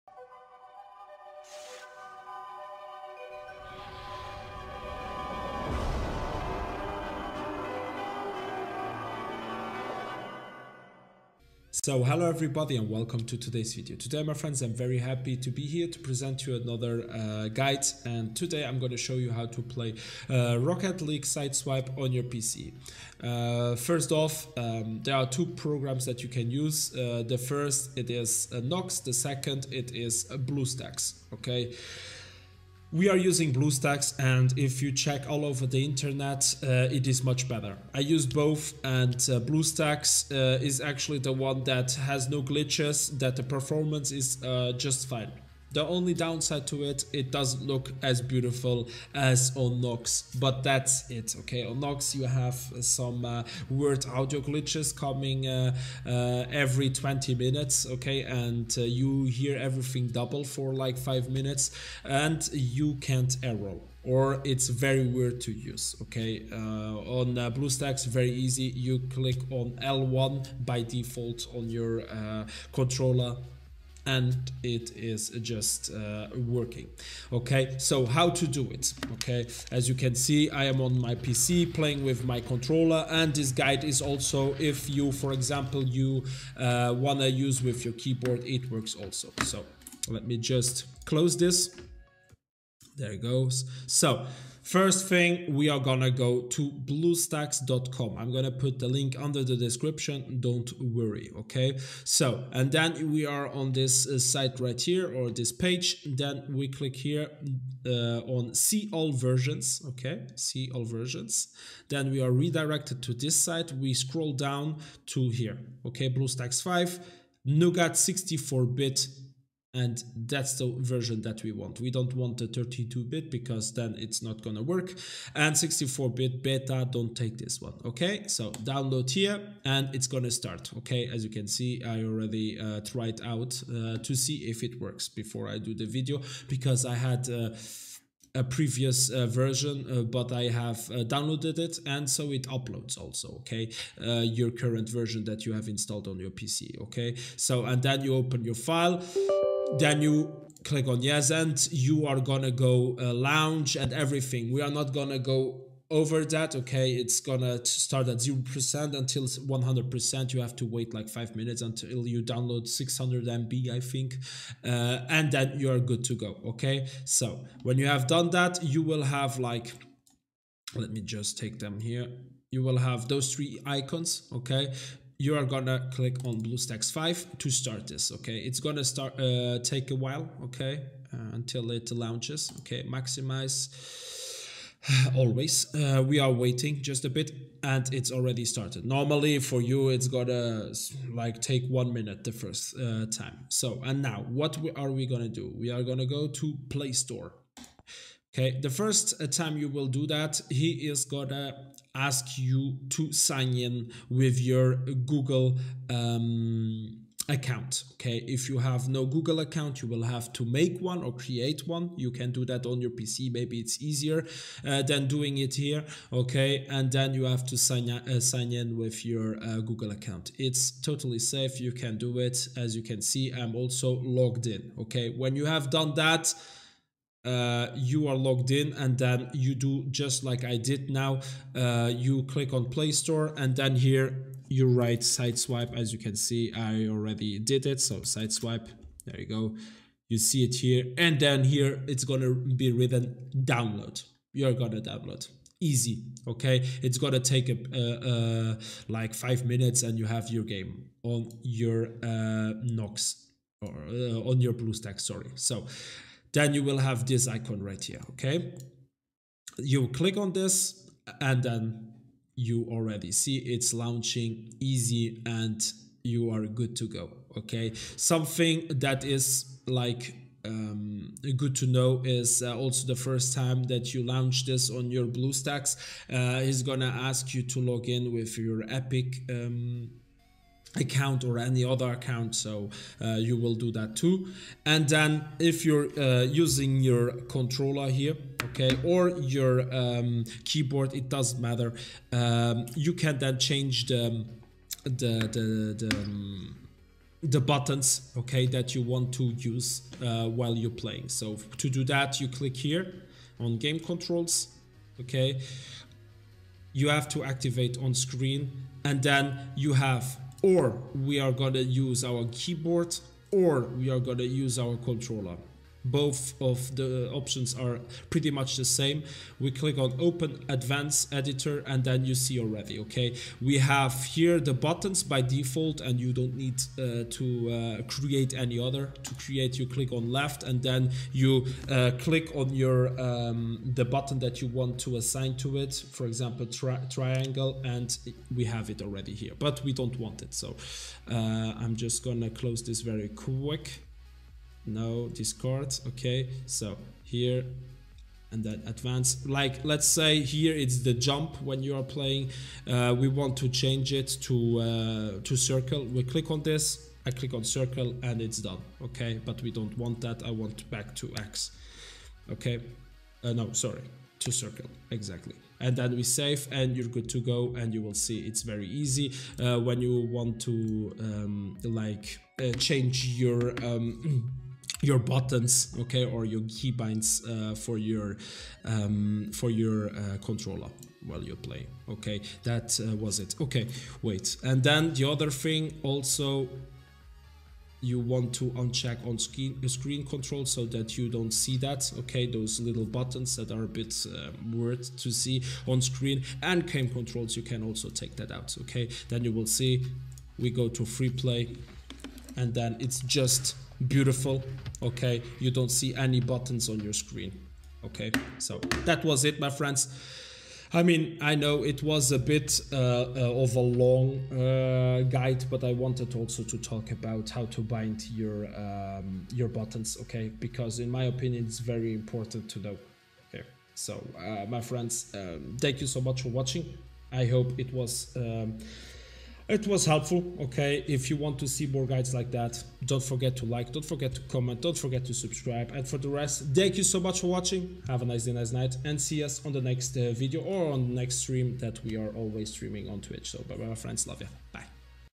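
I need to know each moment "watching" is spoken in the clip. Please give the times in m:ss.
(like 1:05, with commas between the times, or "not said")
7:06, 7:17.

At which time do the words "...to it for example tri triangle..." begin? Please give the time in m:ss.
5:35.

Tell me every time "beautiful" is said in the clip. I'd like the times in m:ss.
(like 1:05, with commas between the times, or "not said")
0:48, 6:43.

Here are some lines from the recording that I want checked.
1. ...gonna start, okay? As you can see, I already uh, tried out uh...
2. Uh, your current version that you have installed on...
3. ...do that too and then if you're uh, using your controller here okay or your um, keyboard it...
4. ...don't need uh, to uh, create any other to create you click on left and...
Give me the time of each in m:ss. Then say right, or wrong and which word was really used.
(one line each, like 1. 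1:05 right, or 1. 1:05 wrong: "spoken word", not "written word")
1. 2:10 right
2. 2:24 right
3. 4:43 right
4. 5:26 right.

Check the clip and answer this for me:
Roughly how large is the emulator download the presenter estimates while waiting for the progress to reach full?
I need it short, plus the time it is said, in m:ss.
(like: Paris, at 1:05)
600 MB, at 2:42.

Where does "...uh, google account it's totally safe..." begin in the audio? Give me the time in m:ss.
3:39.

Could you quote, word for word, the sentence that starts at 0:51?
On Nox you have some uh, weird audio glitches coming uh, uh, every 20 minutes, okay?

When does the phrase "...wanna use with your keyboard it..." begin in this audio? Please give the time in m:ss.
1:26.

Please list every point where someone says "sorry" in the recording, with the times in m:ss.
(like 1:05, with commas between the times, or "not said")
4:14, 6:03.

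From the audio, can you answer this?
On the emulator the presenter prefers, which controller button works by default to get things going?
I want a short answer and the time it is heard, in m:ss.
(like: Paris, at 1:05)
L1, at 1:09.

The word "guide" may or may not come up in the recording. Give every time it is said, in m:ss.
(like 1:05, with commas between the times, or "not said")
0:17, 1:23, 6:55, 7:11.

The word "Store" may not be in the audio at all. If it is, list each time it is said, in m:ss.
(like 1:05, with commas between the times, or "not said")
3:16, 3:52.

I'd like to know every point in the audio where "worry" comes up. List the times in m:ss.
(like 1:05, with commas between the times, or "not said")
1:40.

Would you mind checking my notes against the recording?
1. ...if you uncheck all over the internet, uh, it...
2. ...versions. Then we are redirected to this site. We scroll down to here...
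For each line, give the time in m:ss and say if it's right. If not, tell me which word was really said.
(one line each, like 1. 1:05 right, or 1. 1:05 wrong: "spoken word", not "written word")
1. 0:34 wrong: "check", not "uncheck"
2. 1:50 right.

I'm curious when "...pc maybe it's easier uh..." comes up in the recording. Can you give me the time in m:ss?
3:32.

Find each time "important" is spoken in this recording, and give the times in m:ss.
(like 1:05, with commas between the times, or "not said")
7:01.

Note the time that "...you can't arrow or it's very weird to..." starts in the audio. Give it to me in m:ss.
1:02.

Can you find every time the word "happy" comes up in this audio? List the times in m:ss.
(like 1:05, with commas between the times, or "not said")
0:14.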